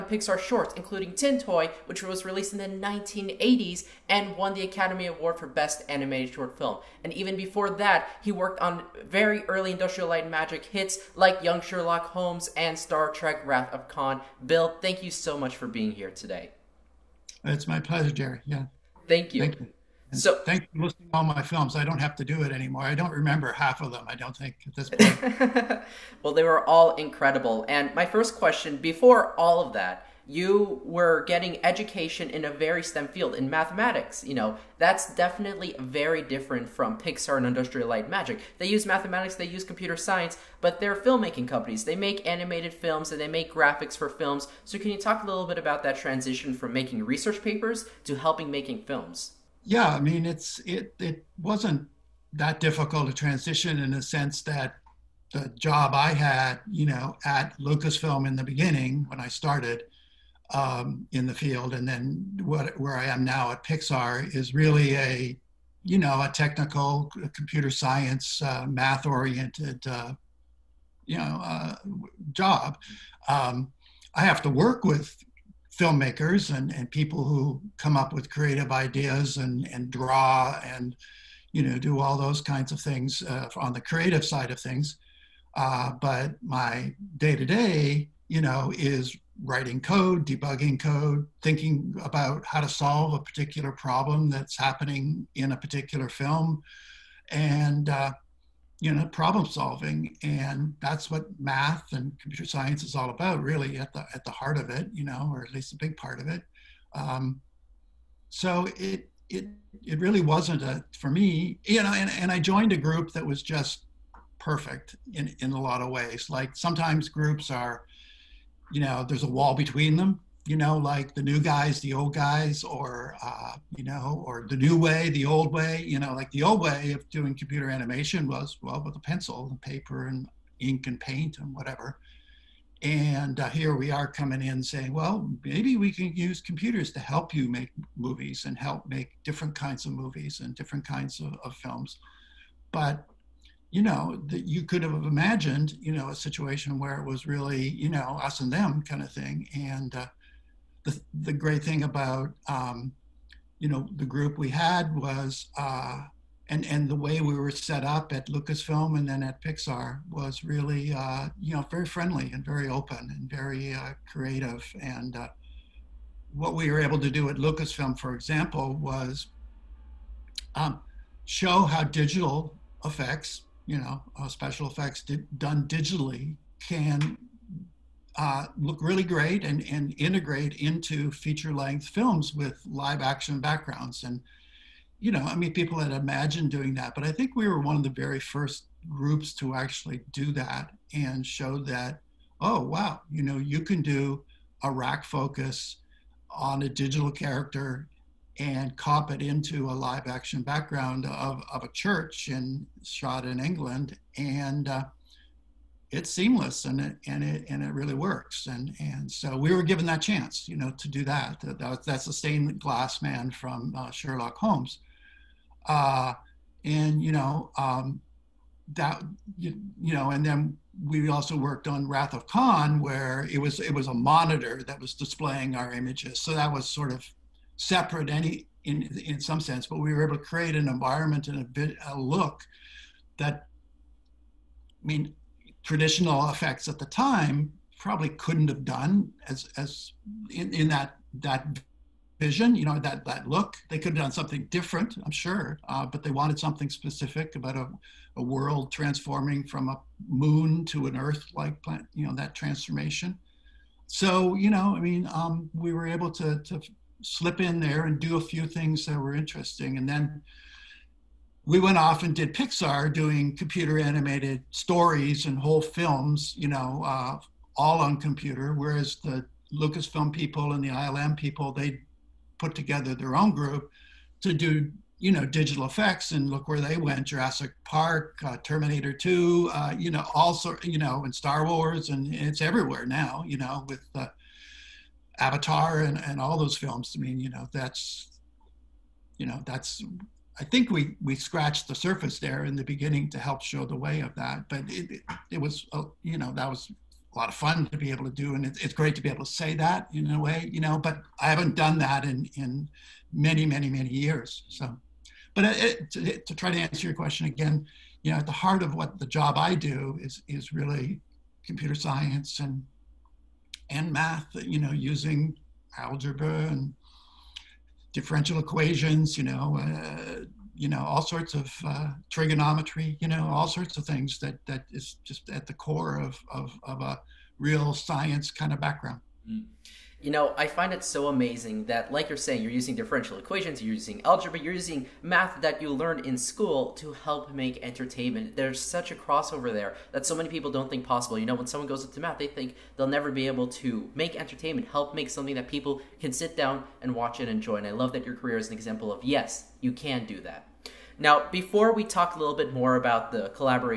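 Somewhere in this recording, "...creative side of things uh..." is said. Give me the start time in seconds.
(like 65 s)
83 s.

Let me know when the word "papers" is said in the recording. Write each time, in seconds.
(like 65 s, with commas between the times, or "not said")
47 s, 129 s.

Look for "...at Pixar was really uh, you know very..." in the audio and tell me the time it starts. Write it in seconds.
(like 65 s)
159 s.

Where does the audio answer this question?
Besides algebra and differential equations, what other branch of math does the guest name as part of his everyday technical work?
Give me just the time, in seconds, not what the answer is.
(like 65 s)
322 s.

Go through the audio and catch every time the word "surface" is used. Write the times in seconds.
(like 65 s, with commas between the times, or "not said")
291 s.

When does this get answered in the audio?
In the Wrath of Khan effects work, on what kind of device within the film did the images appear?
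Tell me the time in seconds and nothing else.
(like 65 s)
223 s.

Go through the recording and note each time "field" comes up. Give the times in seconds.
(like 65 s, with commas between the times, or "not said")
33 s, 61 s.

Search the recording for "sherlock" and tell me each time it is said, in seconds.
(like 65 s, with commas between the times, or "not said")
11 s, 213 s.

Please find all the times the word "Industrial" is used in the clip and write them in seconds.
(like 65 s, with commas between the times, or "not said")
9 s, 37 s.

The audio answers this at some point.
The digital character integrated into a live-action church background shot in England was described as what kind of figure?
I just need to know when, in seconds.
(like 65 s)
212 s.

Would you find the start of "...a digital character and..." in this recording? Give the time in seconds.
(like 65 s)
196 s.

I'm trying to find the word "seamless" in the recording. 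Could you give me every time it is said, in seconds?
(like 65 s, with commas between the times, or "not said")
206 s.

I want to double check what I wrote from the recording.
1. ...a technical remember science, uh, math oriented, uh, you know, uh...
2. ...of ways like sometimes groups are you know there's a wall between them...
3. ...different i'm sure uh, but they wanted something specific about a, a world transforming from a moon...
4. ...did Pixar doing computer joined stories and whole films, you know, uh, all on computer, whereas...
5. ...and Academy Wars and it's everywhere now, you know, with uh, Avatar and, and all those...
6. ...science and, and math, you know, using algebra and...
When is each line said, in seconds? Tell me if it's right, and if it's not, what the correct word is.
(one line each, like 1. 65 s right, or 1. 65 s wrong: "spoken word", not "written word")
1. 66 s wrong: "computer", not "remember"
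2. 115 s right
3. 244 s right
4. 262 s wrong: "animated", not "joined"
5. 281 s wrong: "Star", not "Academy"
6. 311 s right.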